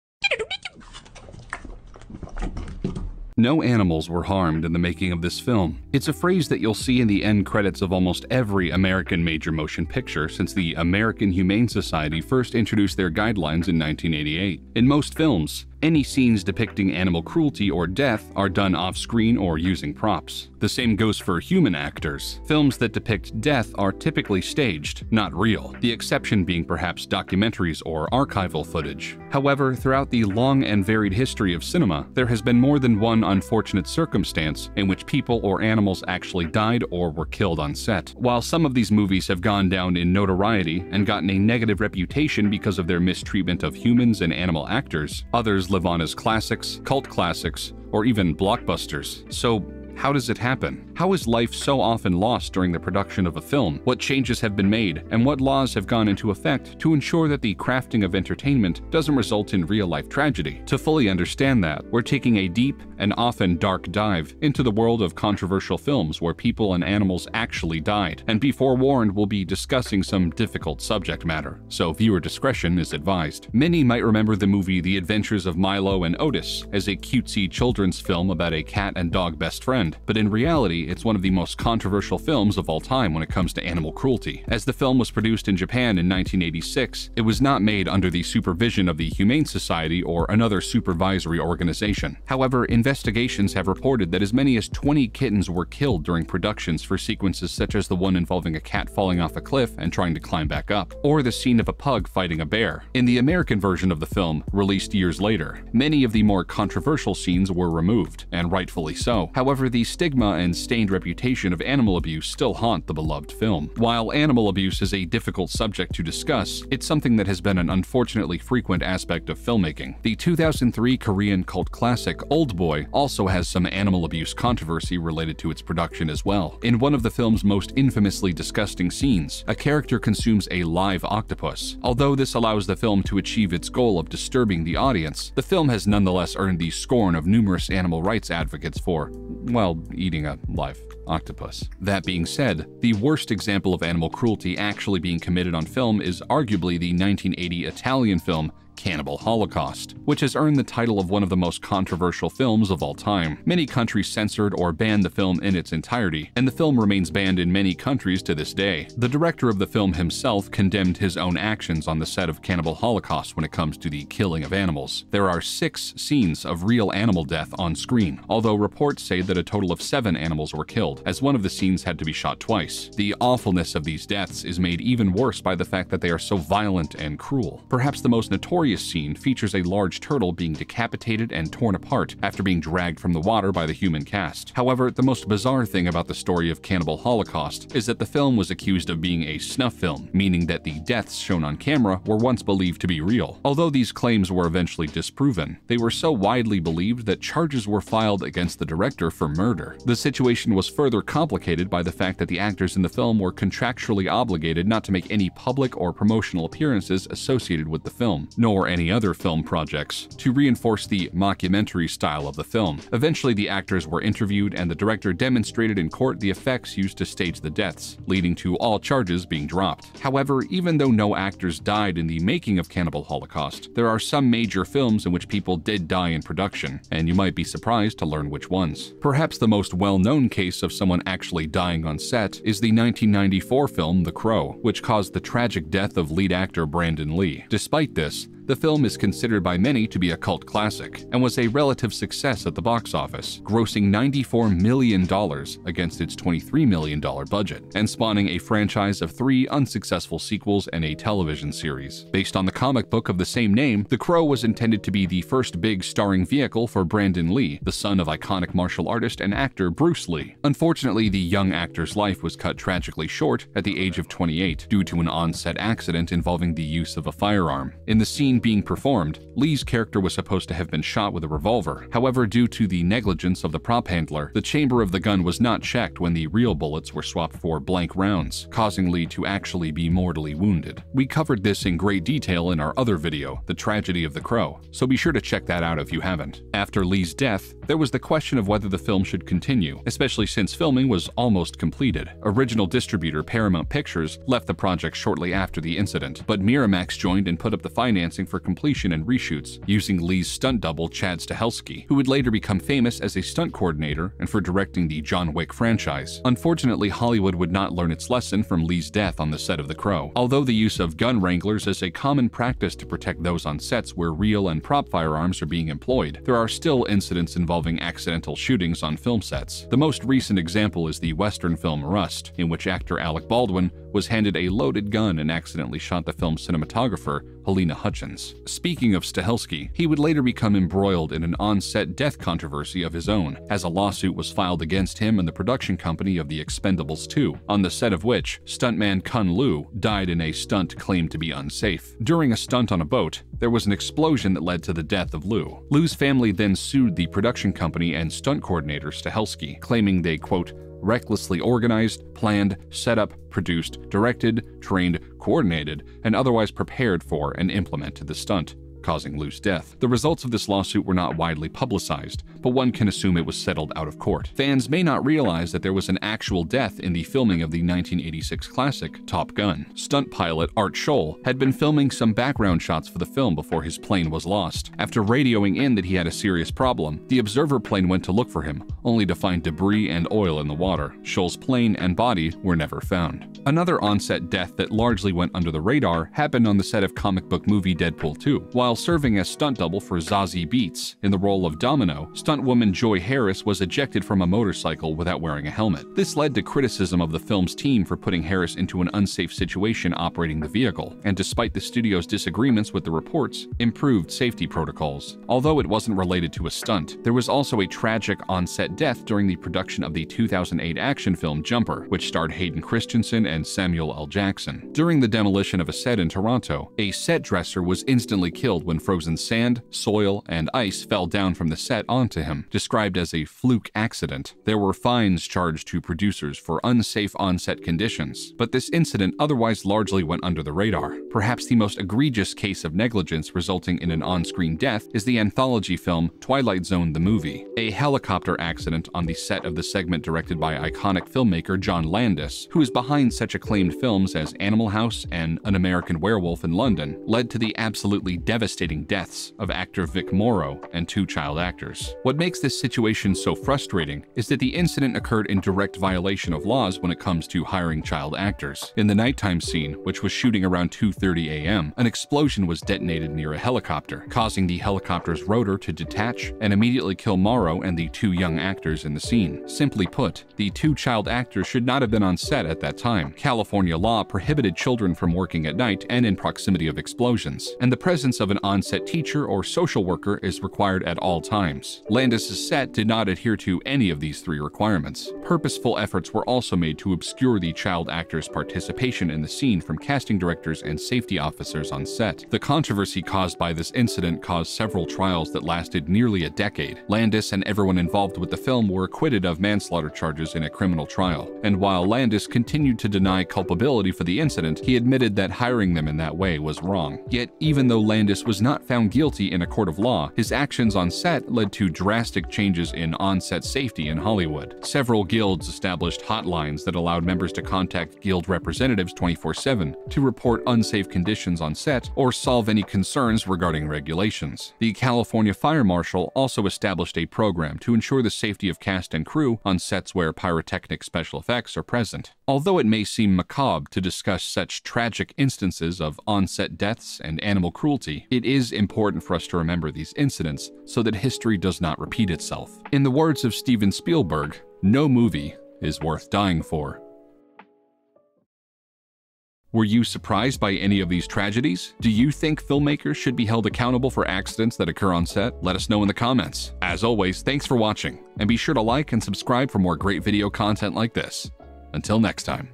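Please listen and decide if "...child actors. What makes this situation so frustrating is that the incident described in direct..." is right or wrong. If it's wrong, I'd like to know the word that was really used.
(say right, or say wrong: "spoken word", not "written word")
wrong: "occurred", not "described".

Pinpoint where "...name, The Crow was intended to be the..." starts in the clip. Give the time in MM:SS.
04:13.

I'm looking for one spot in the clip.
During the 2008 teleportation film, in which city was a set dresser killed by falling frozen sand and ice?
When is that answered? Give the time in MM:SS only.
06:56.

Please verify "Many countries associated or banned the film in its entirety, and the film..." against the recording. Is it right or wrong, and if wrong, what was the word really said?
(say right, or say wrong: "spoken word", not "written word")
wrong: "censored", not "associated".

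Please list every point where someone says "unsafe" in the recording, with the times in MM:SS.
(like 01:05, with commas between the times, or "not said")
05:41, 06:38, 07:06, 08:40.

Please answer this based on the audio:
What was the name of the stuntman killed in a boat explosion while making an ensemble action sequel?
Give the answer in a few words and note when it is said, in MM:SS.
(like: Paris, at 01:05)
Kun Lu, at 05:39.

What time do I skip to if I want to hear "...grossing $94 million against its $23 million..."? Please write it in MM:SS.
04:03.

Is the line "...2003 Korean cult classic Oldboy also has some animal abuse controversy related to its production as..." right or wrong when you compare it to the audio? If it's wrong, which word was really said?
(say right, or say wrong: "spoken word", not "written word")
right.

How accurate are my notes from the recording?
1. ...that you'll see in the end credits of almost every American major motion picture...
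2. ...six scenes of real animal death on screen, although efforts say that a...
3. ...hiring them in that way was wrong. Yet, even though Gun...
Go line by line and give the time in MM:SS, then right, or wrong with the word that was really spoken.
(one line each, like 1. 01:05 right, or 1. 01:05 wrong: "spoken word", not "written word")
1. 00:06 right
2. 02:45 wrong: "reports", not "efforts"
3. 08:25 wrong: "Landis", not "Gun".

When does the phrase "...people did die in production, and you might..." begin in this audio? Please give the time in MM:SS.
03:45.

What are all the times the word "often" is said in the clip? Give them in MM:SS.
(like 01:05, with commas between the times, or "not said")
00:51, 01:03.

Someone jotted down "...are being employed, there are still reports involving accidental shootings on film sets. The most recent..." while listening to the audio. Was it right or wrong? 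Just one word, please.
wrong.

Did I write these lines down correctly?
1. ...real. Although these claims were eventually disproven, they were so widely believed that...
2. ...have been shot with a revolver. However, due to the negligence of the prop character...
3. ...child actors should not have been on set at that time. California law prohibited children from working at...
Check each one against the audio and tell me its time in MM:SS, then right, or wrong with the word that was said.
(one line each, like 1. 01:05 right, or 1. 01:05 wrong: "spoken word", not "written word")
1. 03:13 right
2. 04:30 wrong: "handler", not "character"
3. 07:50 right.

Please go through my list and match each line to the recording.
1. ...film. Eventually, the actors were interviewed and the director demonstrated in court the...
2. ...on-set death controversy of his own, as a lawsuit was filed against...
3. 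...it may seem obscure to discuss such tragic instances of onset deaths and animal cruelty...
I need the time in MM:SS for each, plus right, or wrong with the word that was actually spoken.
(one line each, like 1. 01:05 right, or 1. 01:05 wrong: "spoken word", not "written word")
1. 03:32 right
2. 05:31 right
3. 08:52 wrong: "macabre", not "obscure".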